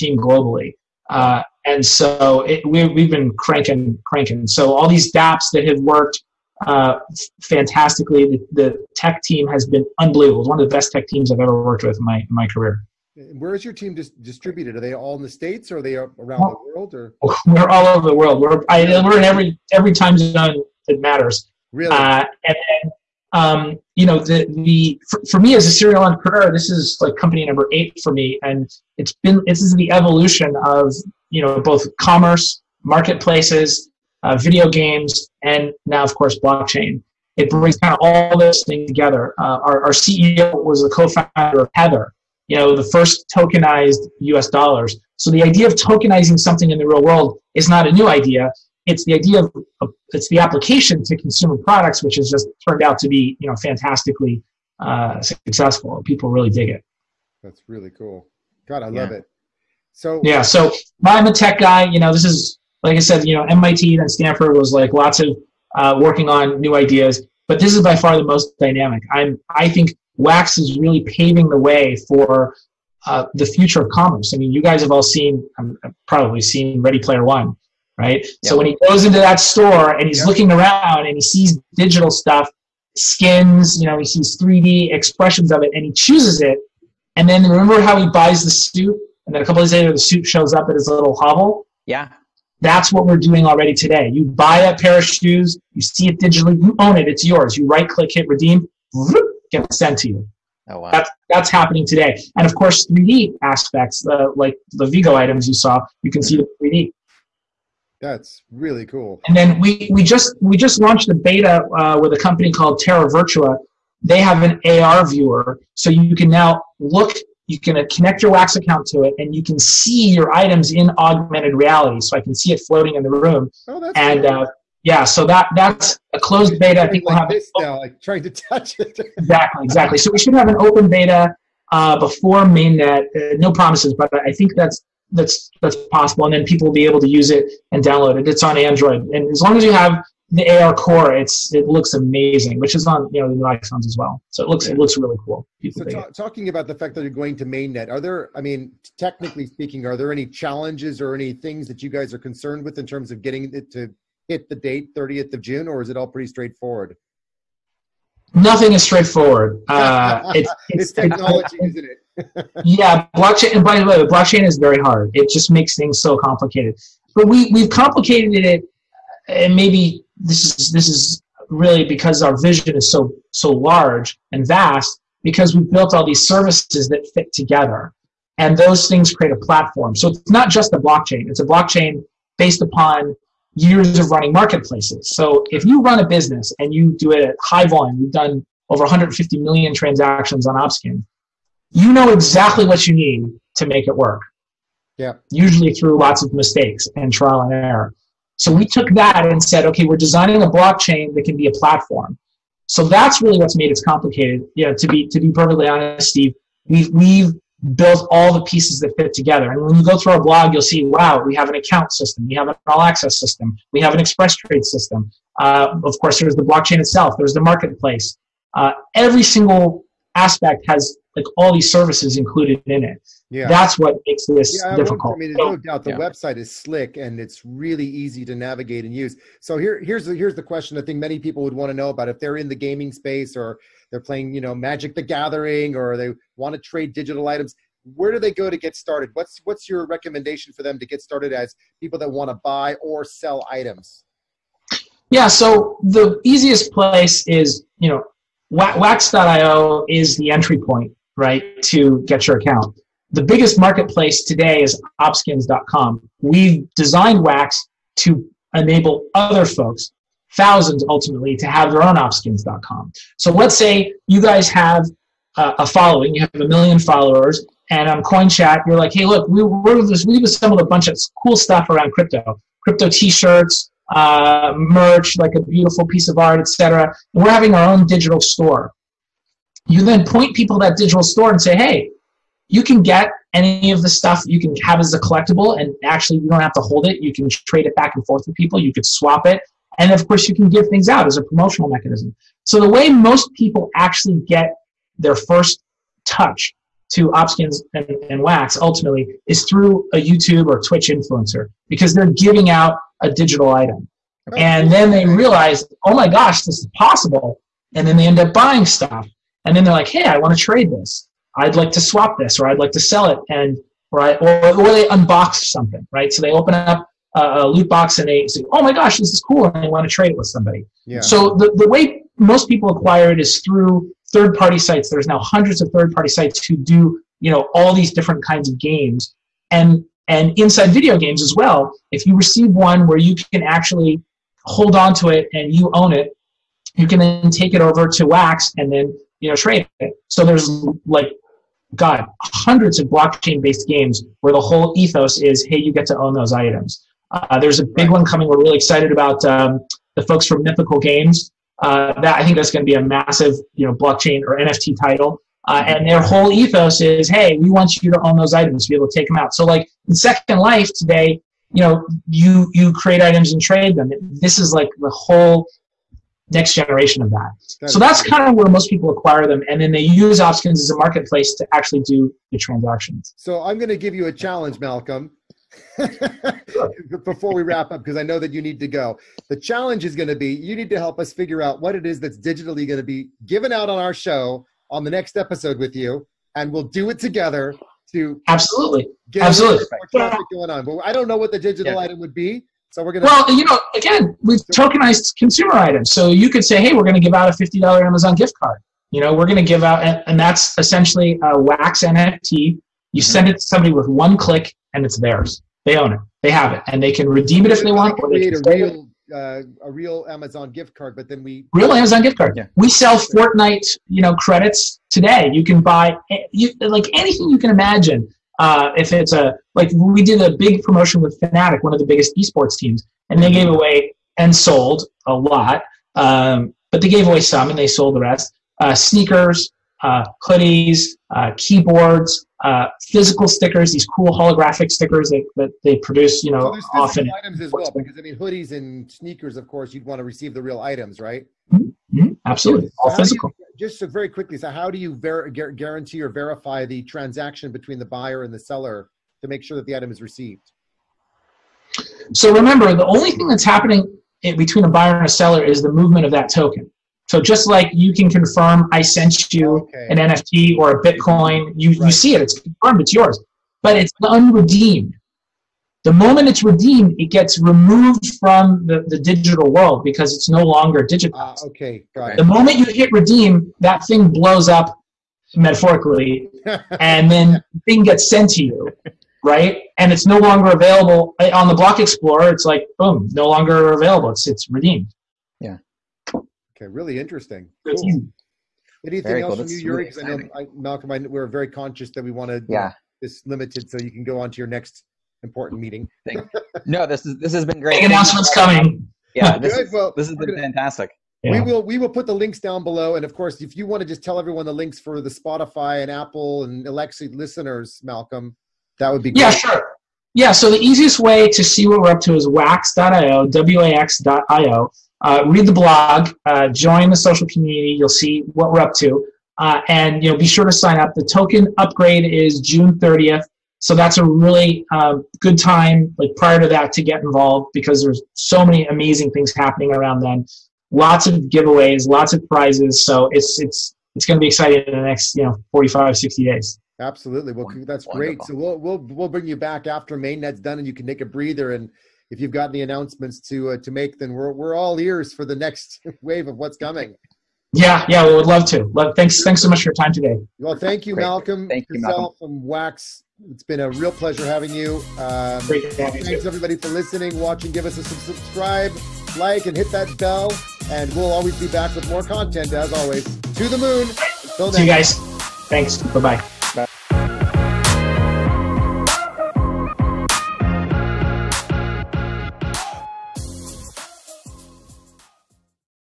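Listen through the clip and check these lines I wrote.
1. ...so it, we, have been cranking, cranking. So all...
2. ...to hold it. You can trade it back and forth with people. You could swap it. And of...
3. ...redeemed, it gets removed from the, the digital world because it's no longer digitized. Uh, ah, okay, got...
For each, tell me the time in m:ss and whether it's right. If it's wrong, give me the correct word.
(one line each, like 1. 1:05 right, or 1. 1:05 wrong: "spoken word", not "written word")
1. 0:01 right
2. 4:46 right
3. 7:46 right.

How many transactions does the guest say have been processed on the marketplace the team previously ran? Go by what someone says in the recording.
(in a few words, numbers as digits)
over 150 million.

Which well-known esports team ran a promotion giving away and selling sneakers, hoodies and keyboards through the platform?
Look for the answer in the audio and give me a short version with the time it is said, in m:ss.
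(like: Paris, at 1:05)
Fnatic, at 7:01.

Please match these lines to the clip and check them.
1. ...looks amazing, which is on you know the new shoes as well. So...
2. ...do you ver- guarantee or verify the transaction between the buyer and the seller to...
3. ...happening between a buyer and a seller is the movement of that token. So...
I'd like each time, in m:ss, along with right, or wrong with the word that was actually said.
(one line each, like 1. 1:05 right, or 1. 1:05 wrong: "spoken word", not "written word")
1. 2:21 wrong: "iPhones", not "shoes"
2. 7:24 right
3. 7:33 right.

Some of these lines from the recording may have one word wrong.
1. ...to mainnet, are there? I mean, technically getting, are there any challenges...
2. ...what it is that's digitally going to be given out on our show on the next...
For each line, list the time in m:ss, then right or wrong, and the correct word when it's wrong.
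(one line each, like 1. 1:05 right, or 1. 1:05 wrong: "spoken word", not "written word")
1. 2:27 wrong: "speaking", not "getting"
2. 6:21 right.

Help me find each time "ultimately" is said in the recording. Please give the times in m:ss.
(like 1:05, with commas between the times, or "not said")
4:20, 4:58.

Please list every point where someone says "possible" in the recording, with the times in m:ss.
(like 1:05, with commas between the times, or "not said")
2:15, 5:06.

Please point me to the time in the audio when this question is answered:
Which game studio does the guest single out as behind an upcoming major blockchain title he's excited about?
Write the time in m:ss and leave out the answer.
5:50.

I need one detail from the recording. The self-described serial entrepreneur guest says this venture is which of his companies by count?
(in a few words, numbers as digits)
8.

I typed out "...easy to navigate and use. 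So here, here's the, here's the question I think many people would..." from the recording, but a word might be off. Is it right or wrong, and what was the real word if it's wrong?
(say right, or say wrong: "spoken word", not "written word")
right.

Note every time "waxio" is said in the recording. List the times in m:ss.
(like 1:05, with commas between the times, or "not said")
4:08, 8:32.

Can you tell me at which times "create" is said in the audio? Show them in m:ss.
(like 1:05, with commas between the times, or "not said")
2:59, 6:02.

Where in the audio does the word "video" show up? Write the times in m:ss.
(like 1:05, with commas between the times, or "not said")
0:34, 5:30.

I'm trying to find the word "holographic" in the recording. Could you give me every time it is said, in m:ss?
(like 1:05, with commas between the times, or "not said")
7:14.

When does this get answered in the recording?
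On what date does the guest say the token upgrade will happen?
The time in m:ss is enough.
8:42.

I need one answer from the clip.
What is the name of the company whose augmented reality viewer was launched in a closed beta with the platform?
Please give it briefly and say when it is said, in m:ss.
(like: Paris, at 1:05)
Terra Virtua, at 1:52.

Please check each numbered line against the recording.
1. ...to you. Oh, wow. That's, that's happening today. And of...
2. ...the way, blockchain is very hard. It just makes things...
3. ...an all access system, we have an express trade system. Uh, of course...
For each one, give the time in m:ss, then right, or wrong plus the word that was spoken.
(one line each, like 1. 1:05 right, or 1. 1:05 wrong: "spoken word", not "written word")
1. 1:39 right
2. 2:43 right
3. 3:32 right.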